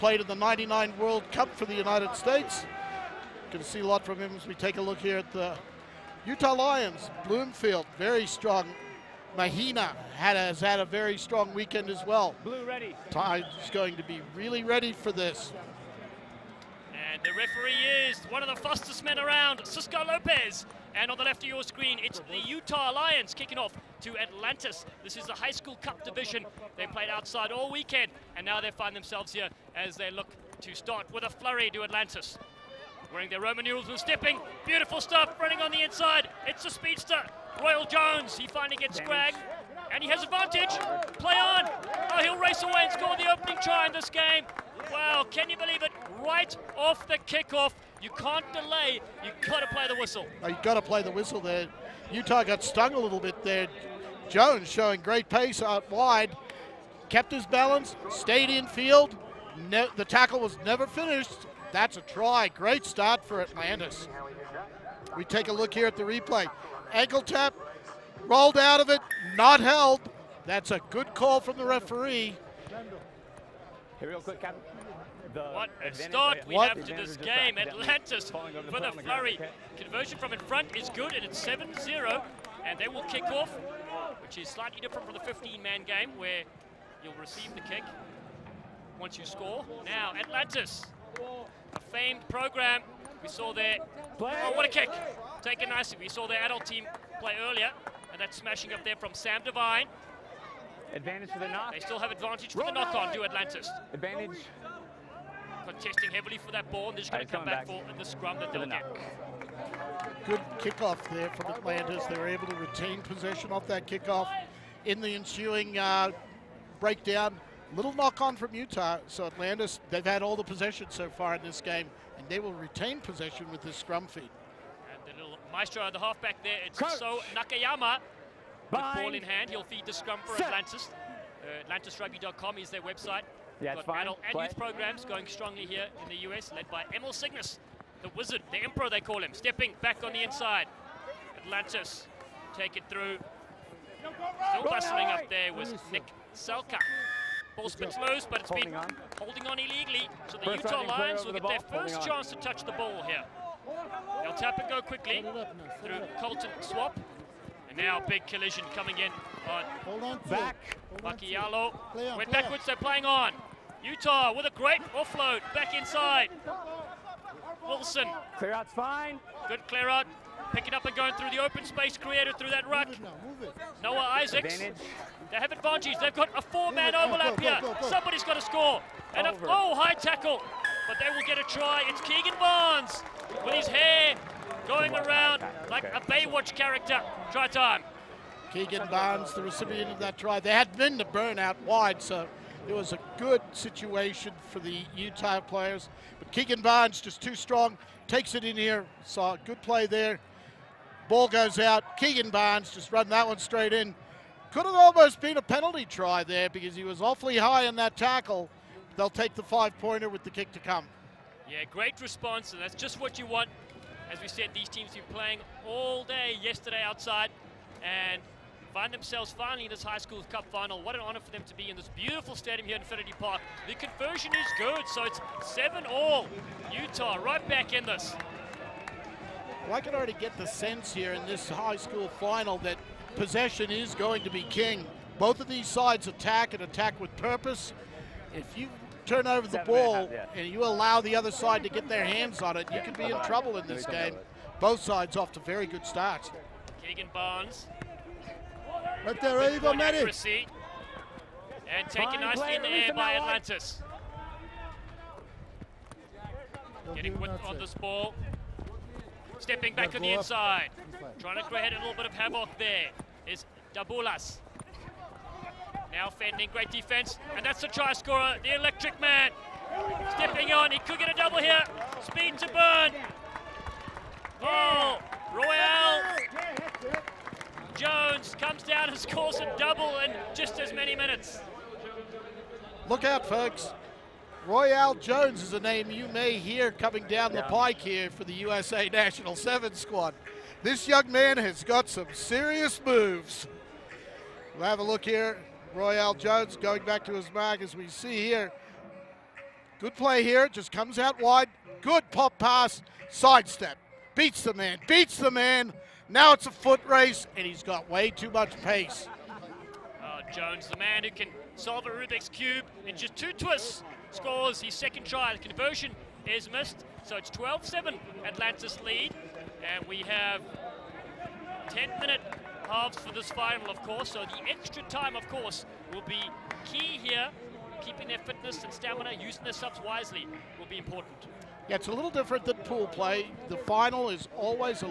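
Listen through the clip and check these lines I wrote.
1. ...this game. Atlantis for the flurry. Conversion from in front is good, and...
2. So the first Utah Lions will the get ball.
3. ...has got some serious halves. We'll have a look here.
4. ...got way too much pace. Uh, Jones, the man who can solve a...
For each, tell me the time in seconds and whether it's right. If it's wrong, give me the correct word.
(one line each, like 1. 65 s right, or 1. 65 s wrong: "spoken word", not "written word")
1. 76 s right
2. 150 s right
3. 291 s wrong: "moves", not "halves"
4. 307 s right.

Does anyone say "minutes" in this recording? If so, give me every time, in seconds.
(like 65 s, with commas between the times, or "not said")
280 s, 321 s.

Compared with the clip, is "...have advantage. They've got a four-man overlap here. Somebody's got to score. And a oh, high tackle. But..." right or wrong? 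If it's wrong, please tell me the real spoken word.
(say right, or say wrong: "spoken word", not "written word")
right.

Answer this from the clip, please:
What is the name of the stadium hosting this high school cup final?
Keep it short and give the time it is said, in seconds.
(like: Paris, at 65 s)
Infinity Park, at 222 s.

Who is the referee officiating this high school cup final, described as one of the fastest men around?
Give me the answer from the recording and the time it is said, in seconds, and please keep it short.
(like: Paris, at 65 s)
Cisco Lopez, at 19 s.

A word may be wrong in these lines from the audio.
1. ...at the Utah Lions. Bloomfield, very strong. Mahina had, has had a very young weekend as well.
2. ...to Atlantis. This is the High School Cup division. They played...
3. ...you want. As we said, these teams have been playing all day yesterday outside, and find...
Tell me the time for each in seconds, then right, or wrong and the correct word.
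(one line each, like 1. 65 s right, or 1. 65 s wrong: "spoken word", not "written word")
1. 5 s wrong: "strong", not "young"
2. 24 s right
3. 213 s right.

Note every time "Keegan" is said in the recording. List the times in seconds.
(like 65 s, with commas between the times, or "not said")
182 s, 188 s, 196 s, 201 s, 246 s.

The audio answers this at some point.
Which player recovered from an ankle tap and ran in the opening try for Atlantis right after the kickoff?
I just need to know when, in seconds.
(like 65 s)
37 s.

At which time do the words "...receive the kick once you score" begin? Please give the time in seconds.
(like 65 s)
87 s.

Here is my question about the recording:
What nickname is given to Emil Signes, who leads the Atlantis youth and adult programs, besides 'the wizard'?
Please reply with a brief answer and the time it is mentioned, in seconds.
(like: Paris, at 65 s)
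the emperor, at 138 s.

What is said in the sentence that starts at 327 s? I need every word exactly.
Keeping their fitness and stamina, using their subs wisely, will be important.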